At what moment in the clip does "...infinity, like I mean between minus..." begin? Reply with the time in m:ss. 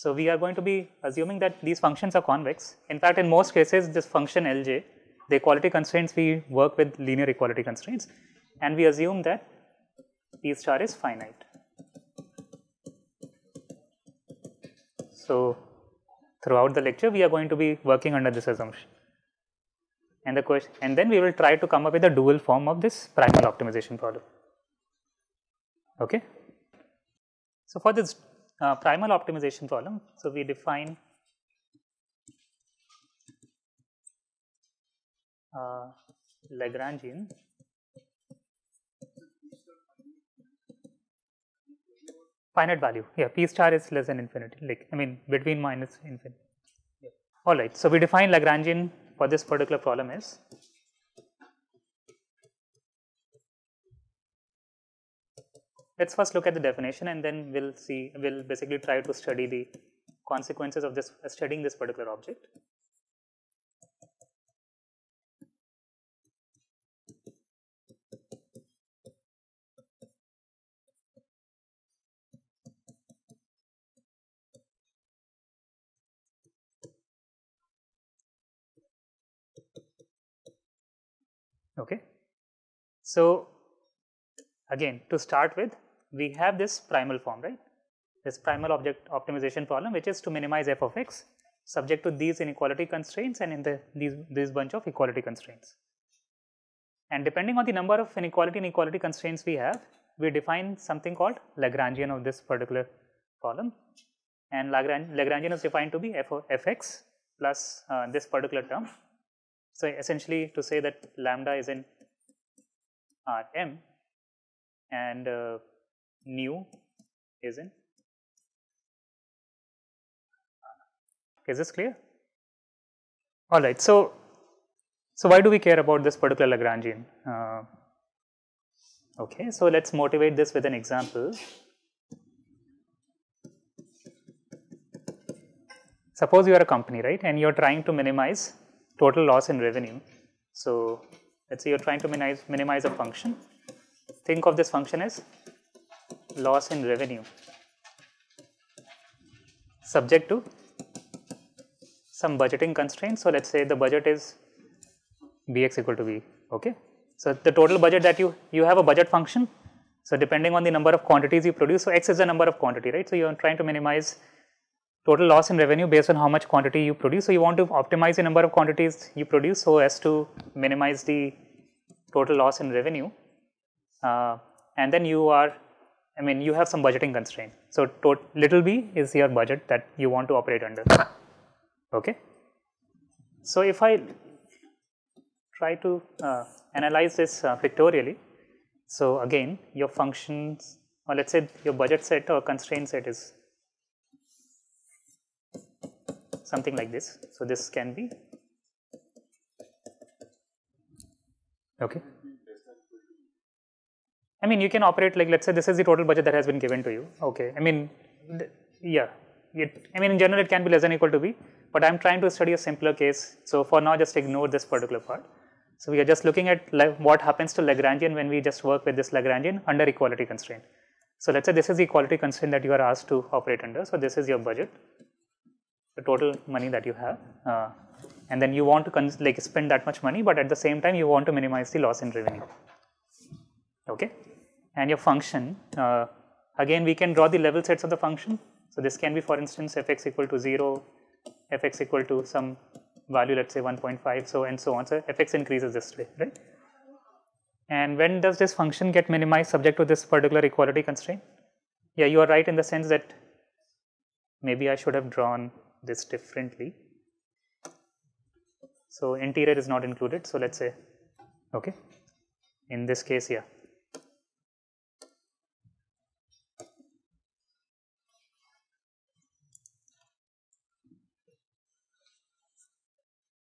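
0:44.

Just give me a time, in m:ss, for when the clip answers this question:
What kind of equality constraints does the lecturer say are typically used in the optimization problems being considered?
0:06.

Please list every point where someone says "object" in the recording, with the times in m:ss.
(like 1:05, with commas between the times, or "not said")
1:02, 1:28.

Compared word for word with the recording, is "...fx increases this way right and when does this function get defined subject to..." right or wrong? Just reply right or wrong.
wrong.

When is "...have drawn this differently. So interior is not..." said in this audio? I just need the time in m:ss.
4:14.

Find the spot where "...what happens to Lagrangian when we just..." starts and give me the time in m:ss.
3:37.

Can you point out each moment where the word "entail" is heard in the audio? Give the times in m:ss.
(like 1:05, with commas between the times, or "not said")
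not said.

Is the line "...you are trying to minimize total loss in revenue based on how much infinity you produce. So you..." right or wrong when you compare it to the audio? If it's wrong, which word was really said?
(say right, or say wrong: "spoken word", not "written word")
wrong: "quantity", not "infinity".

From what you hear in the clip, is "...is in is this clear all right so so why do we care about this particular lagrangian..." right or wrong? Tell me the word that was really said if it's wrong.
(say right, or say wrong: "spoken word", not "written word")
right.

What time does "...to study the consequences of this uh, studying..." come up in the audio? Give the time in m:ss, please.
0:59.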